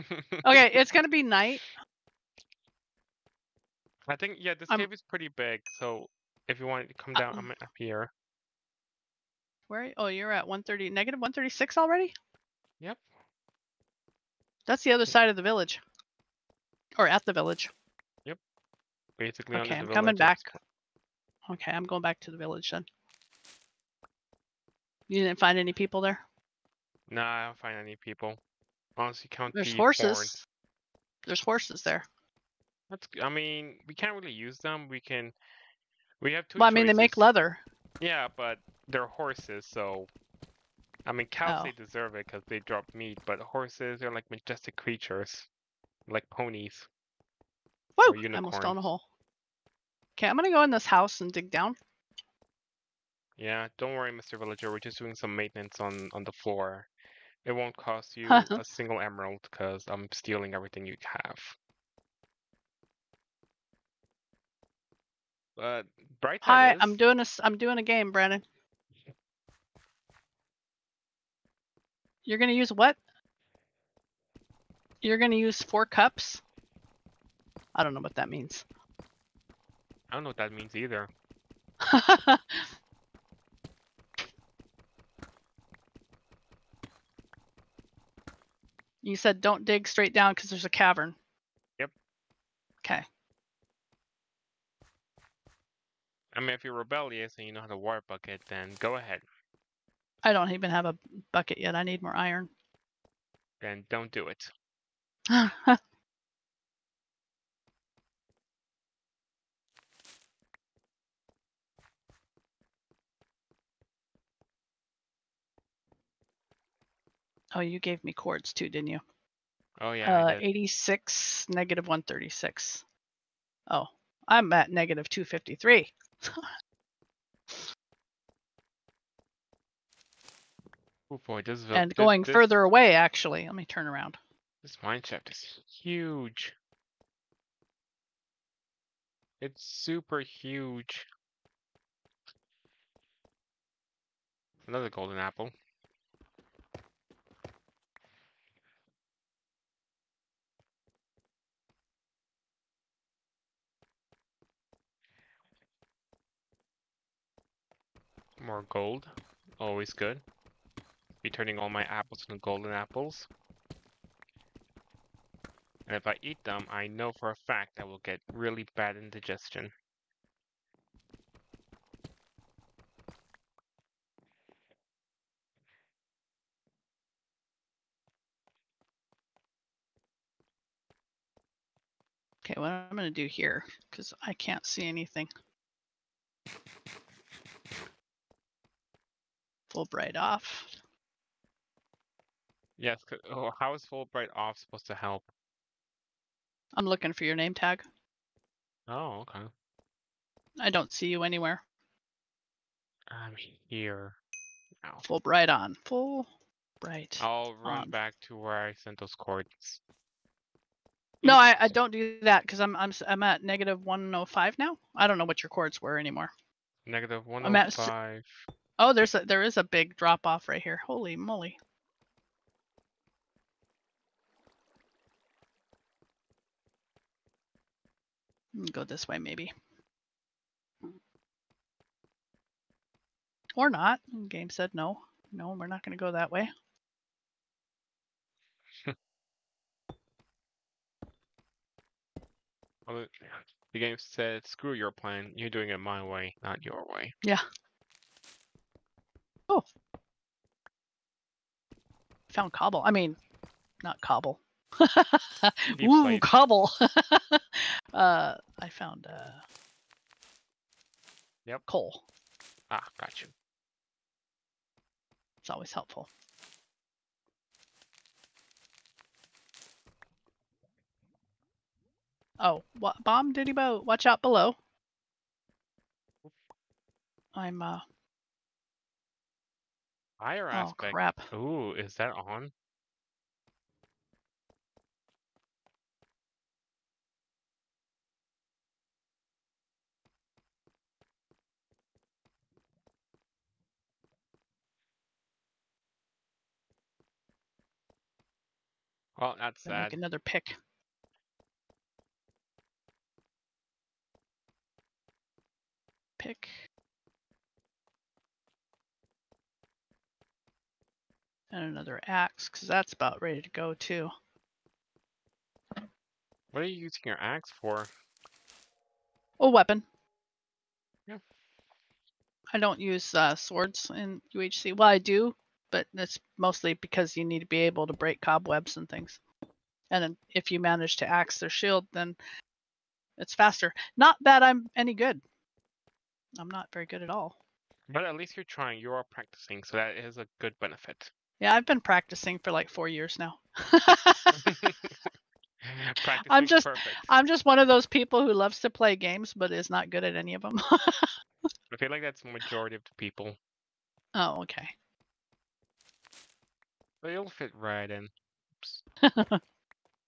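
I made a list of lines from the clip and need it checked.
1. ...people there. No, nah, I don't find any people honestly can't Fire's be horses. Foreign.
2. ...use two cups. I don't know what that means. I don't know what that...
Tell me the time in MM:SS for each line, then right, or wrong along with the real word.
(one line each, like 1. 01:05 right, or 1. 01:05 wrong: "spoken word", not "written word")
1. 00:25 wrong: "There", not "Fire"
2. 01:15 wrong: "four", not "two".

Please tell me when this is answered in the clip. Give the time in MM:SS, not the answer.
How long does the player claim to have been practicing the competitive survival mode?
05:42.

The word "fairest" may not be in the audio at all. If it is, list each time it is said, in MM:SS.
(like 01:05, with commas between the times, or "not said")
not said.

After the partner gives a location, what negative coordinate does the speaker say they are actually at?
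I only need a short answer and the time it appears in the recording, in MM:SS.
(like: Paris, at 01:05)
-253, at 02:04.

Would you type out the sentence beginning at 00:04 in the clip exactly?
I think yeah, this um, cave is pretty big, so if you want to come uh, down, uh, I'm mm.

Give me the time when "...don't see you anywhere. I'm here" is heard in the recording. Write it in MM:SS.
03:20.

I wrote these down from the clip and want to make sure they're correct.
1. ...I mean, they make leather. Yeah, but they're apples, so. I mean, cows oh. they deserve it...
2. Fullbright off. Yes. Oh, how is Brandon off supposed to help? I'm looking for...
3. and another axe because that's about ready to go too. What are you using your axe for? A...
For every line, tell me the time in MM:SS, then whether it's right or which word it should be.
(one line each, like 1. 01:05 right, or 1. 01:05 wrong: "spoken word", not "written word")
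1. 00:36 wrong: "horses", not "apples"
2. 03:09 wrong: "Fullbright", not "Brandon"
3. 05:11 right.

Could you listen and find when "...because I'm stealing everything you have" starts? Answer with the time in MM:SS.
00:59.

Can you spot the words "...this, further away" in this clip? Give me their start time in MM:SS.
02:12.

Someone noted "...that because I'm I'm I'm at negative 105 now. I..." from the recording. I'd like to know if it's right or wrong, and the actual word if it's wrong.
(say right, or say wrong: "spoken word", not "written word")
right.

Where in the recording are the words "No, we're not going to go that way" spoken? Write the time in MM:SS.
03:55.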